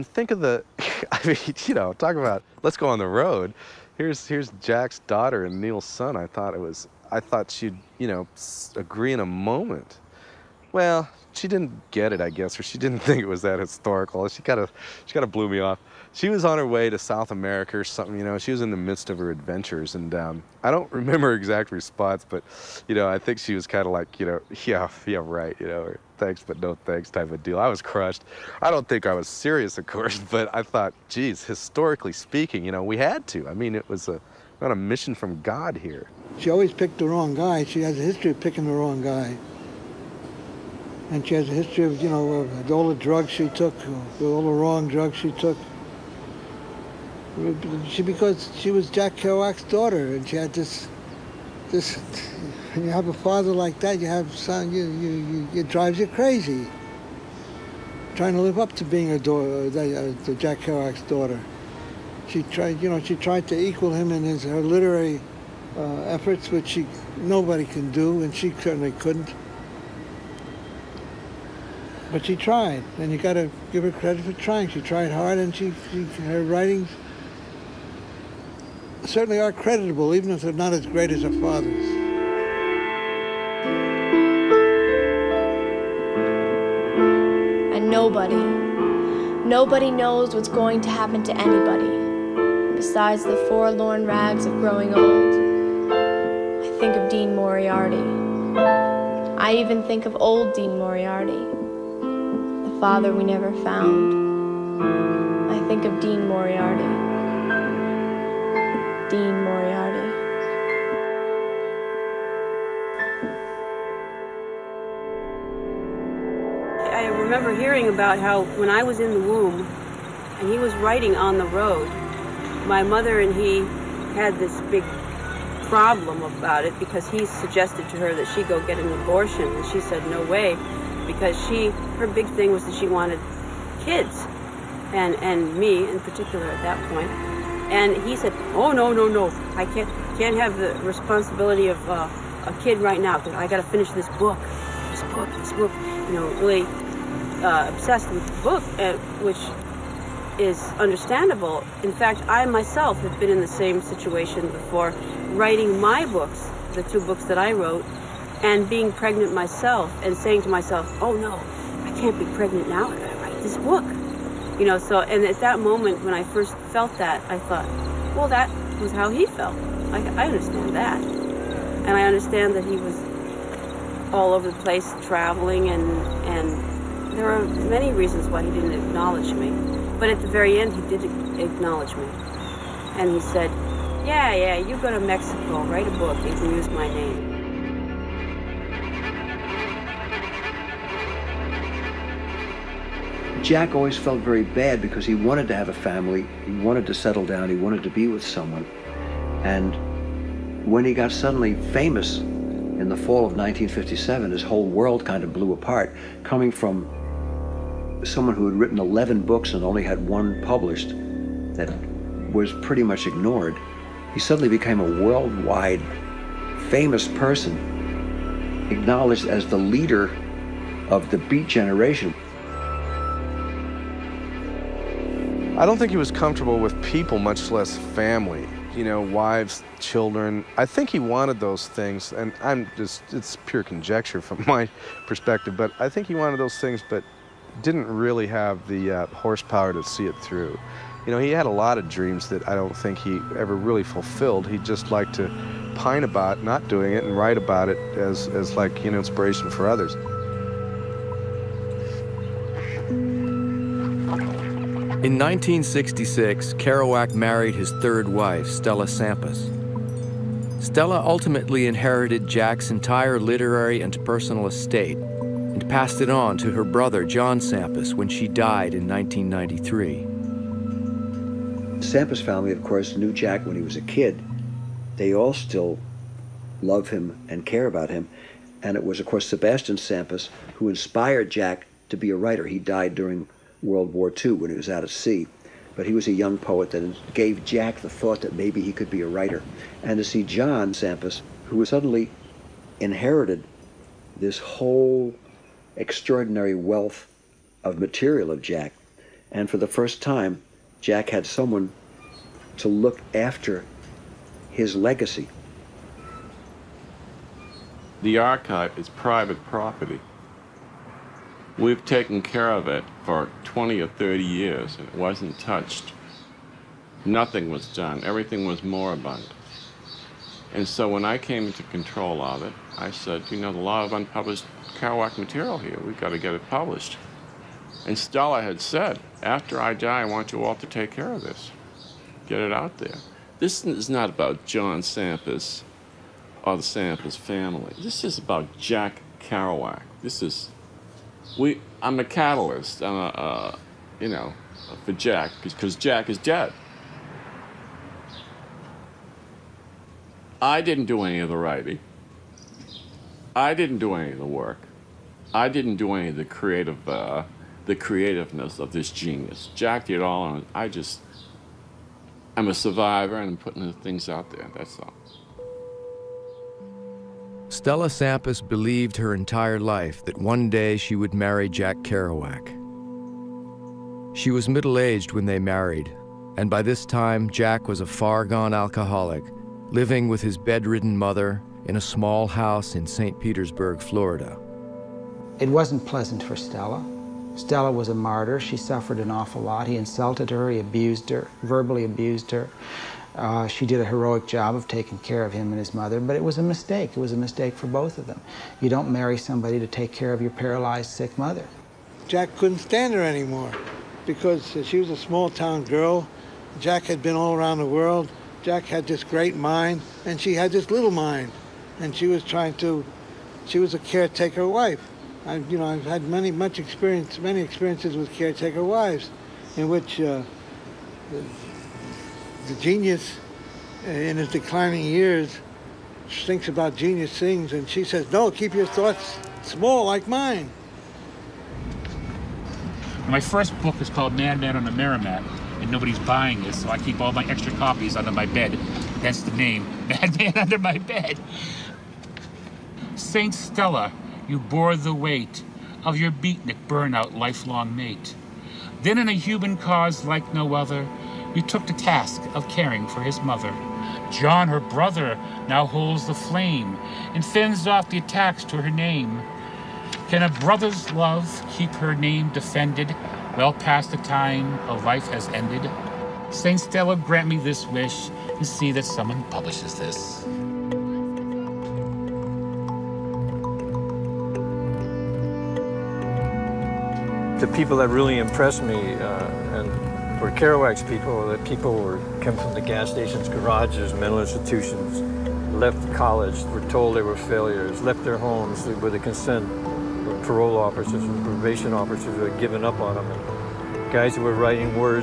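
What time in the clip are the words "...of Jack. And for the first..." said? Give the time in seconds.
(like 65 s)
298 s.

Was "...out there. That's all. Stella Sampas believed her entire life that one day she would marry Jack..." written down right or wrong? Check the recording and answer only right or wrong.
right.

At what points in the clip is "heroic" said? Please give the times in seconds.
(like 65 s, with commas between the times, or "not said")
393 s.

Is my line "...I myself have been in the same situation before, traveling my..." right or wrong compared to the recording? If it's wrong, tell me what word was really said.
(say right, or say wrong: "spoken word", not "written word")
wrong: "writing", not "traveling".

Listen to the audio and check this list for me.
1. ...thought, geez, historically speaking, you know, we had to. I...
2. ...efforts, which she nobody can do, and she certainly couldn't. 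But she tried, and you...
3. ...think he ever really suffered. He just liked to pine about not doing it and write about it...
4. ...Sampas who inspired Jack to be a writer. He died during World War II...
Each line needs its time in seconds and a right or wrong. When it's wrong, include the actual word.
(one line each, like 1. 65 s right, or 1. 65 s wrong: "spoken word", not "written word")
1. 30 s right
2. 66 s right
3. 242 s wrong: "fulfilled", not "suffered"
4. 279 s right.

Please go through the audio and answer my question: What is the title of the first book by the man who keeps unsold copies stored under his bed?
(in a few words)
Madman on the Merrimack.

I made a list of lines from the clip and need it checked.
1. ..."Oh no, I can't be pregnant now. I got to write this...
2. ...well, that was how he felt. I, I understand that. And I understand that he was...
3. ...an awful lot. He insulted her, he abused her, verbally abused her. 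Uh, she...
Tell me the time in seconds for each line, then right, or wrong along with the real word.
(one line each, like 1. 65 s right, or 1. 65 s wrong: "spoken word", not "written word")
1. 161 s right
2. 168 s right
3. 388 s right.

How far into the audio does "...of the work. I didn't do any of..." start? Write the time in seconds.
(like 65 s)
354 s.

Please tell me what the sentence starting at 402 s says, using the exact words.
Jack couldn't stand her anymore because uh, she was a small town girl.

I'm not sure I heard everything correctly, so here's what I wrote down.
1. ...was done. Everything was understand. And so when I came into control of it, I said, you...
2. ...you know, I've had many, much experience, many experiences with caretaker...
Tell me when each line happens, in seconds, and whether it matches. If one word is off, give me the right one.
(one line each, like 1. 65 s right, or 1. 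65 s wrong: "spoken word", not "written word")
1. 317 s wrong: "moribund", not "understand"
2. 415 s right.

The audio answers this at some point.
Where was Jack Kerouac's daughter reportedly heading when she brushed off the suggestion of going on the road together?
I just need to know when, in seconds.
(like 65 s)
16 s.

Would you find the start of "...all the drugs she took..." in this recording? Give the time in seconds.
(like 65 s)
42 s.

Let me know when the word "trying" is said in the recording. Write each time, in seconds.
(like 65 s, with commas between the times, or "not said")
58 s, 74 s, 412 s.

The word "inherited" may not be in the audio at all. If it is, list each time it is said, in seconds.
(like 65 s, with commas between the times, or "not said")
261 s, 292 s.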